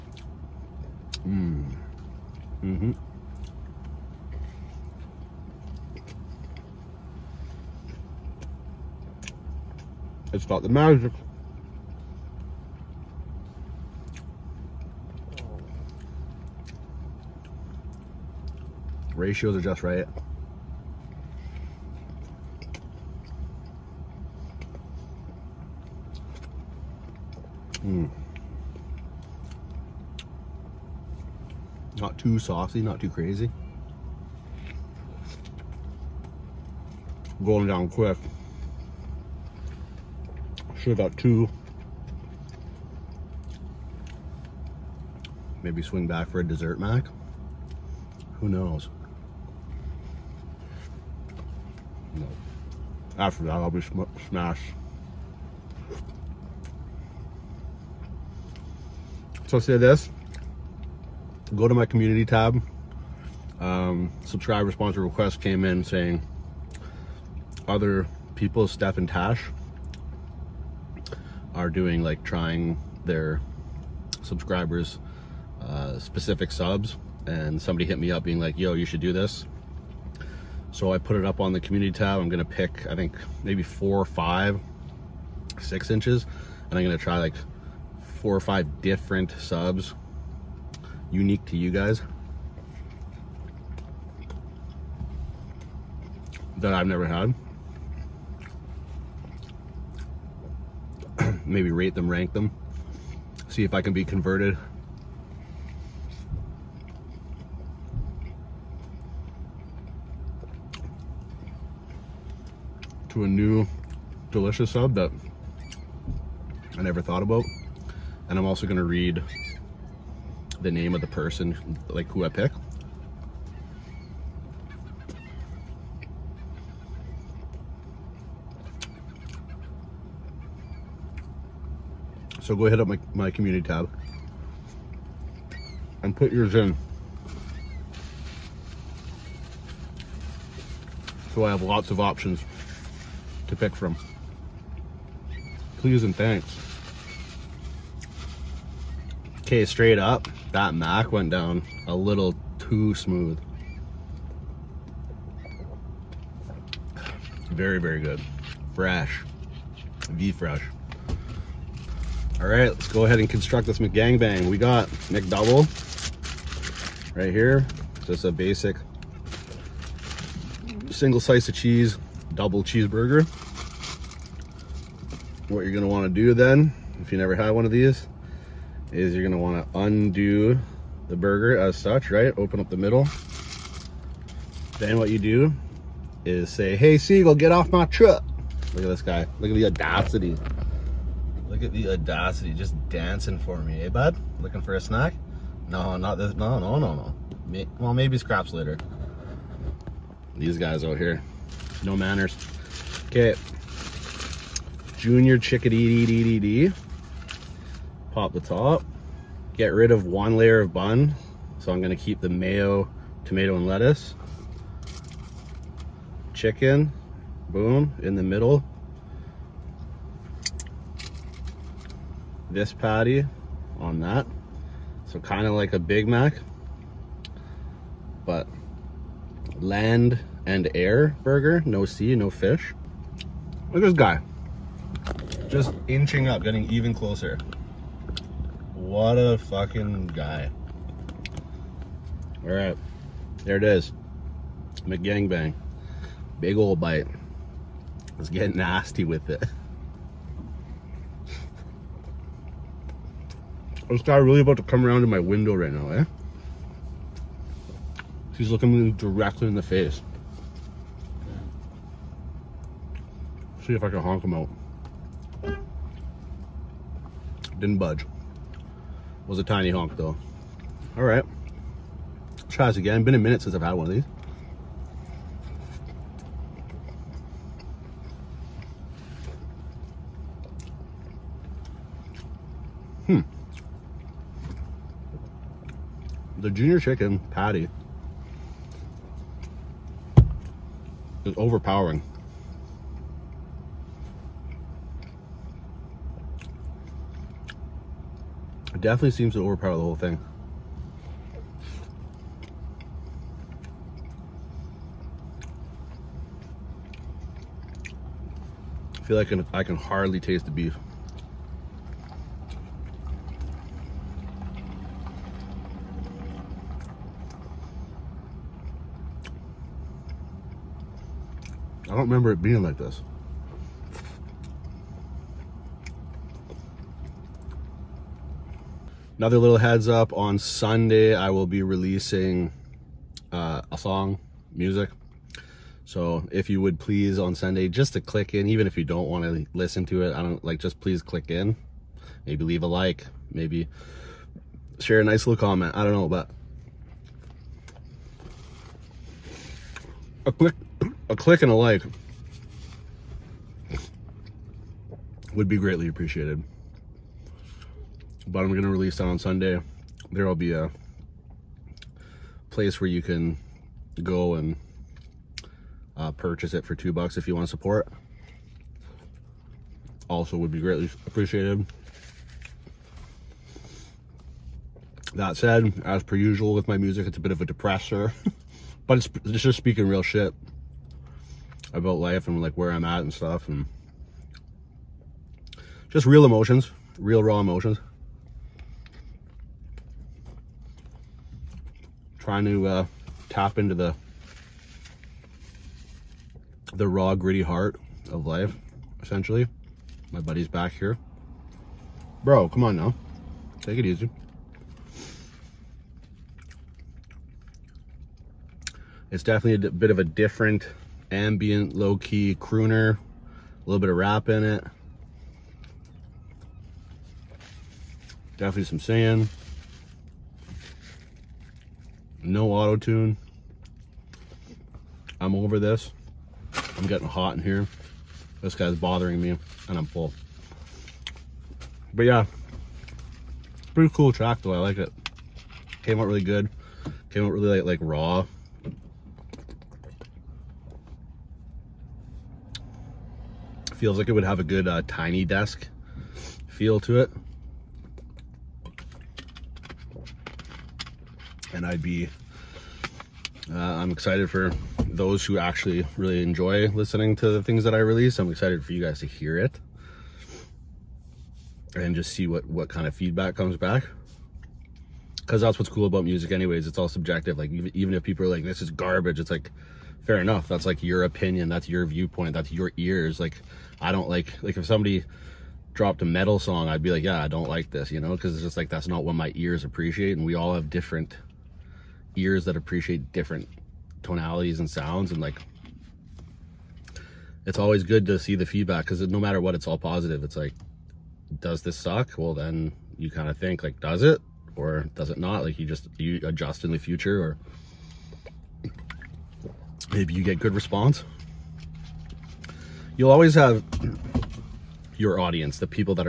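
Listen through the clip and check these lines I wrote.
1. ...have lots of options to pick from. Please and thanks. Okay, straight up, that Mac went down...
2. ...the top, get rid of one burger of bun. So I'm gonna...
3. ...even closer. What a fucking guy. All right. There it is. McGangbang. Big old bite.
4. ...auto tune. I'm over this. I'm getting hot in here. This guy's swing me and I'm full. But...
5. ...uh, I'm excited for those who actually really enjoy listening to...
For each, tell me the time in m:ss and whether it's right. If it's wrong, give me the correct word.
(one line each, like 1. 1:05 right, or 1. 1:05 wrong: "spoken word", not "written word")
1. 2:21 right
2. 3:28 wrong: "layer", not "burger"
3. 3:56 right
4. 7:02 wrong: "bothering", not "swing"
5. 7:33 right.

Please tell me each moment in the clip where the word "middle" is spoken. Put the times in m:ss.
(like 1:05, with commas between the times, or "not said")
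3:02, 3:38.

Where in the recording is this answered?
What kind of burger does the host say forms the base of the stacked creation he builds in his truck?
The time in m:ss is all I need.
2:45.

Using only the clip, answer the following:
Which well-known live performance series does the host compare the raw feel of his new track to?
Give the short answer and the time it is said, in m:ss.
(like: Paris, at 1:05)
Tiny Desk, at 7:24.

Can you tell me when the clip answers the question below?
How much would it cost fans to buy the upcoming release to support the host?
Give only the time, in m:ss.
6:06.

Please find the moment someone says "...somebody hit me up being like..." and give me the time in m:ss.
1:17.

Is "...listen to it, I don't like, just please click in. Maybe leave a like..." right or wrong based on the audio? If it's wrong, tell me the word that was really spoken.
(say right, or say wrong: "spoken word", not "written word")
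right.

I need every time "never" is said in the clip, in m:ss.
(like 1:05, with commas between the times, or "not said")
1:36, 1:56, 2:57.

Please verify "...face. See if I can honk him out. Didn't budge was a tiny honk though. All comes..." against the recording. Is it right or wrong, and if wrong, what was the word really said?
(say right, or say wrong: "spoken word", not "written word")
wrong: "tries", not "comes".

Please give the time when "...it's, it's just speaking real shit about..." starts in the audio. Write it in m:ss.
6:18.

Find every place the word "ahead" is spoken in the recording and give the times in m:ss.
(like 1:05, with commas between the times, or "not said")
2:12, 2:43.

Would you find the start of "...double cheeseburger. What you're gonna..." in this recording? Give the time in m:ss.
2:52.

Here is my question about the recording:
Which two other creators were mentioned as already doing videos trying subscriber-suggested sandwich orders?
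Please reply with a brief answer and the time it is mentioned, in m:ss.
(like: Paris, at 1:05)
Steph and Tash, at 1:08.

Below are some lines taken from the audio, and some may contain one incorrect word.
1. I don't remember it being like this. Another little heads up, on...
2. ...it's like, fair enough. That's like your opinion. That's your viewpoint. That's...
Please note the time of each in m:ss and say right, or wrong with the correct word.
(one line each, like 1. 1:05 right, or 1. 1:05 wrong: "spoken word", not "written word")
1. 5:21 right
2. 7:49 right.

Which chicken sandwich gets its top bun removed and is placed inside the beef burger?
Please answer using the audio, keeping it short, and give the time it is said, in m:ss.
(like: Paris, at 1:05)
Junior Chicken, at 3:24.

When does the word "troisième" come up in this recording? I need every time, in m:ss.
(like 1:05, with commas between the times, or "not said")
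not said.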